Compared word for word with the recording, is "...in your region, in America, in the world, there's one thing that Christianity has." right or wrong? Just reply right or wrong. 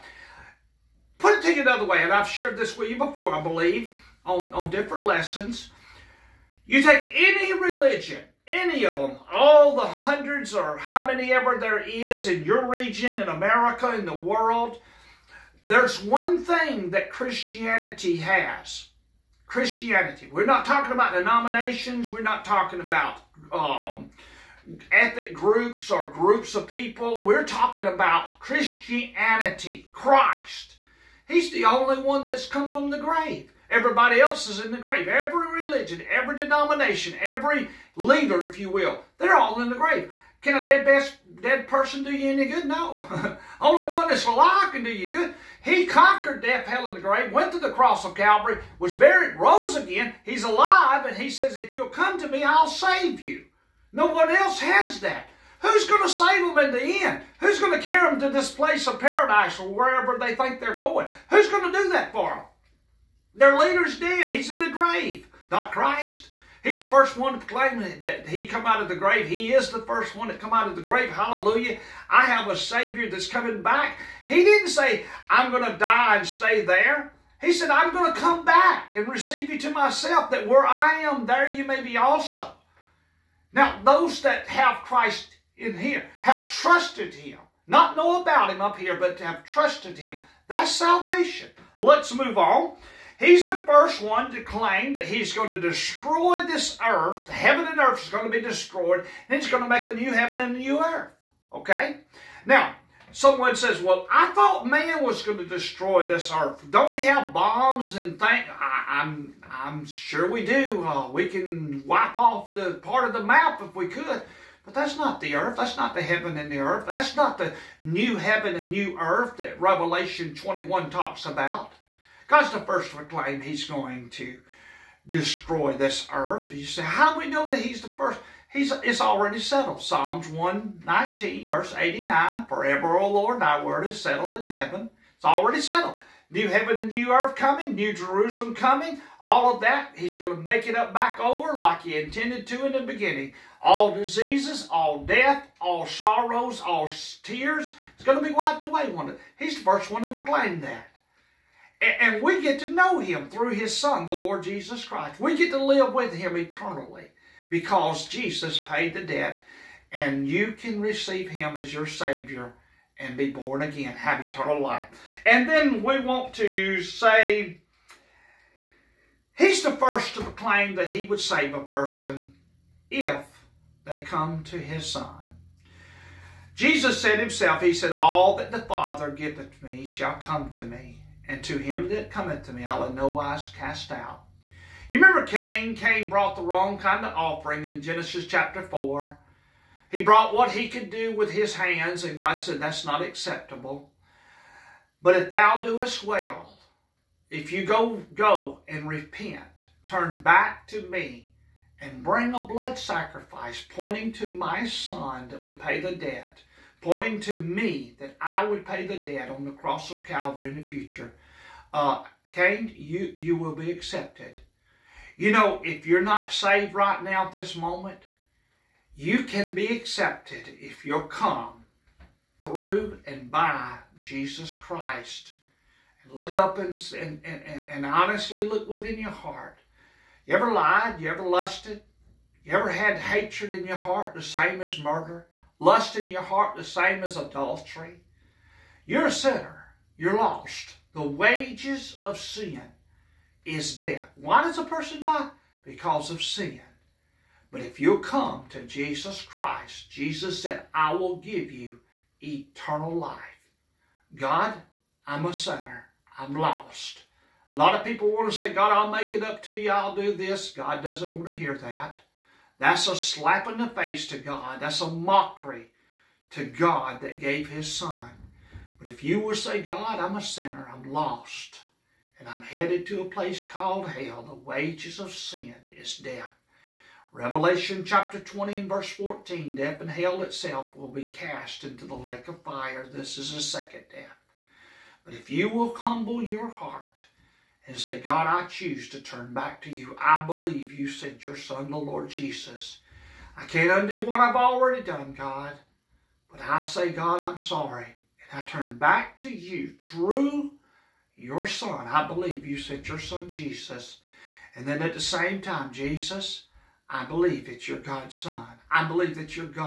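right.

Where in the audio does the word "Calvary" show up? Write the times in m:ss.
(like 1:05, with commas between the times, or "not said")
0:48, 3:30.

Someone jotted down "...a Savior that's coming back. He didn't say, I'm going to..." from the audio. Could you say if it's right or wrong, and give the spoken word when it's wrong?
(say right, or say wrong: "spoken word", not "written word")
right.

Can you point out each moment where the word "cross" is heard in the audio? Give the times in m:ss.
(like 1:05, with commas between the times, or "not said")
0:47, 3:29.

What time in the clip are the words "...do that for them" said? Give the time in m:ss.
1:01.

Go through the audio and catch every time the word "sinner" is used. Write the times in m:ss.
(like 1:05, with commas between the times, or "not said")
3:59, 4:15, 4:30.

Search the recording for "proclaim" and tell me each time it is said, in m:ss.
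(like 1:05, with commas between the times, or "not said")
1:07, 2:02, 2:30, 2:50.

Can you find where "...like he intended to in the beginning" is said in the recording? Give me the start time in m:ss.
2:21.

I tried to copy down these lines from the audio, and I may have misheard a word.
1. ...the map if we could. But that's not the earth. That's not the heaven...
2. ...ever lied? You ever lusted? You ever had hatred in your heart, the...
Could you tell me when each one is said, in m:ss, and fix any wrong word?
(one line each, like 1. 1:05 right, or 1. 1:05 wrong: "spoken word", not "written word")
1. 1:53 right
2. 3:50 right.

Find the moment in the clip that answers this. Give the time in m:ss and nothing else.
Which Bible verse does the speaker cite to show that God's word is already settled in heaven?
2:09.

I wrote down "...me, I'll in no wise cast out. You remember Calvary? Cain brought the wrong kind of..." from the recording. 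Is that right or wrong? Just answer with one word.
wrong.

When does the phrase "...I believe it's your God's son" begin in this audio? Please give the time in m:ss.
5:06.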